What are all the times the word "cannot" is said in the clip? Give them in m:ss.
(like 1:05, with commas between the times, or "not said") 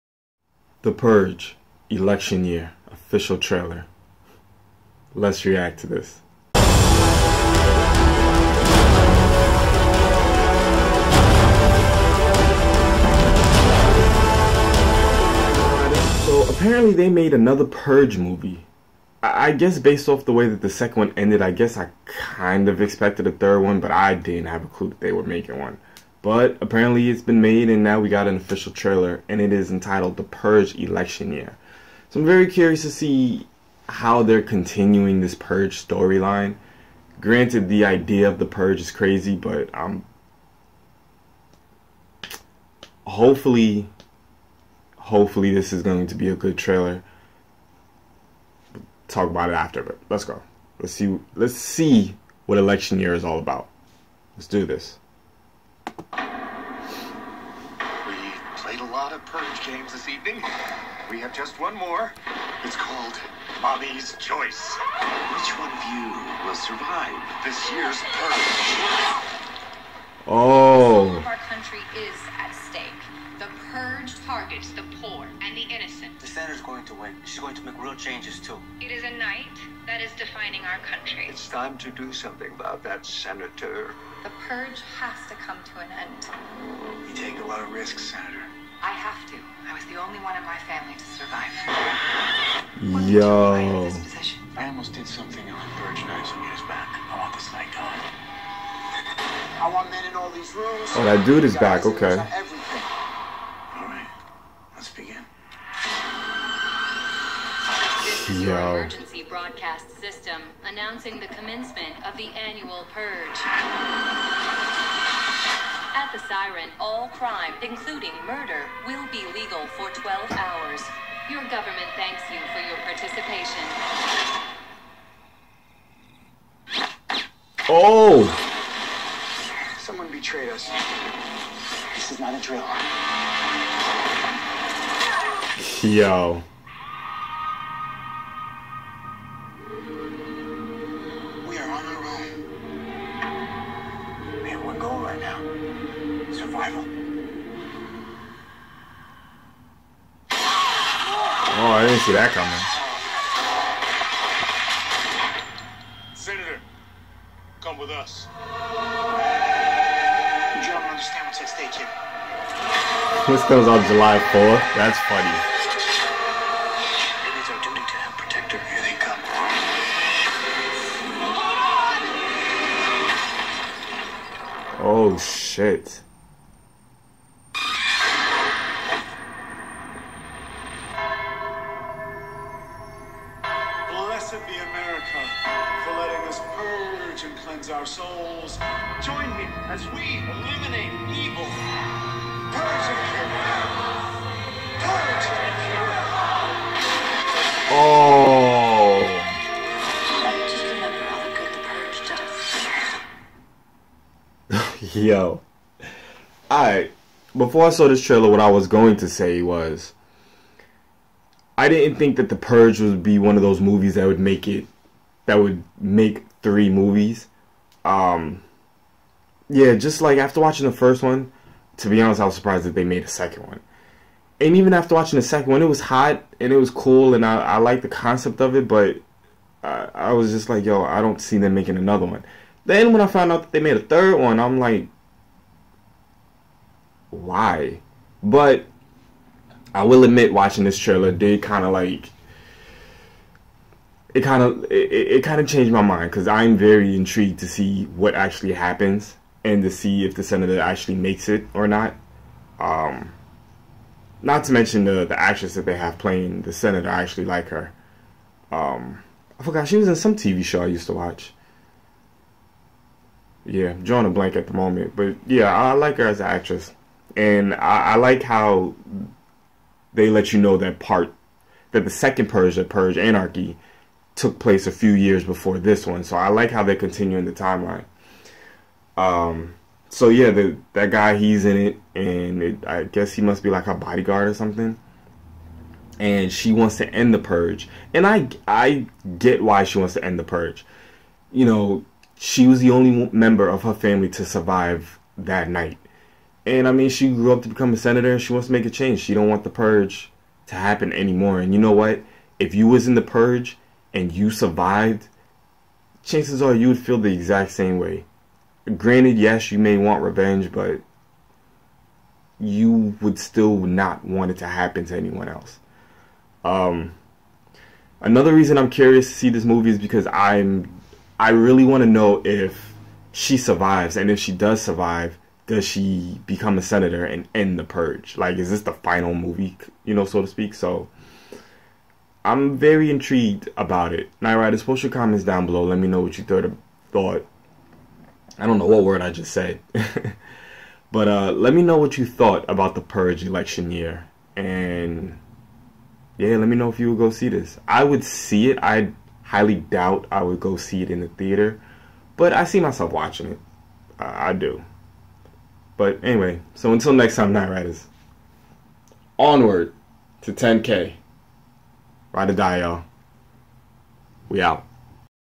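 not said.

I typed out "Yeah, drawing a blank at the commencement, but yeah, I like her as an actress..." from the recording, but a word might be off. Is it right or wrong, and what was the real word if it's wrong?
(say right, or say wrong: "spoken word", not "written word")
wrong: "moment", not "commencement".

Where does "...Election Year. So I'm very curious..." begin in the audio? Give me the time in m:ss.
0:30.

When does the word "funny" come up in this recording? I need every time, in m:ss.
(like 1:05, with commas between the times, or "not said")
2:45.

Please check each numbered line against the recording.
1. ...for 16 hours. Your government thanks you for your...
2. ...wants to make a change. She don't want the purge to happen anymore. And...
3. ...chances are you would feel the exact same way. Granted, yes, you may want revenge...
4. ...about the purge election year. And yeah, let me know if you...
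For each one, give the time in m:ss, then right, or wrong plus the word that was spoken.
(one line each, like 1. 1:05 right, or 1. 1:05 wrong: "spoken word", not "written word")
1. 1:59 wrong: "12", not "16"
2. 4:58 right
3. 5:06 right
4. 5:42 right.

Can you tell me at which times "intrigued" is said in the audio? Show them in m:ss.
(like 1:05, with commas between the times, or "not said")
4:06, 5:32.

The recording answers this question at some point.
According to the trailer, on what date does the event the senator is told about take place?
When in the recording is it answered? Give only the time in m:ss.
2:43.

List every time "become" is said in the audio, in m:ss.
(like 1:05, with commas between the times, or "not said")
4:57, 5:26.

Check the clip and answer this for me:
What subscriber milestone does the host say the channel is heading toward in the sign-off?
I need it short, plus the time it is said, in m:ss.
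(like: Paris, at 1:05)
10K, at 6:00.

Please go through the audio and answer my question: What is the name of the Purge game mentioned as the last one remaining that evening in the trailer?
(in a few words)
Mommy's Choice.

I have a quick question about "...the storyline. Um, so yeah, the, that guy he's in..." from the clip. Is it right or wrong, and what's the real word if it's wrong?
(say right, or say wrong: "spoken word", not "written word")
wrong: "timeline", not "storyline".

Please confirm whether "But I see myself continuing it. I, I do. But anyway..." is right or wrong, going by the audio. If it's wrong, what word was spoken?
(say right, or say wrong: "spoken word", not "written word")
wrong: "watching", not "continuing".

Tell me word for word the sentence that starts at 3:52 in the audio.
Then when I found out that they made a third one, I'm like, why?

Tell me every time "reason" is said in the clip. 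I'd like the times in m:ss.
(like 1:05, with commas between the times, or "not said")
5:18.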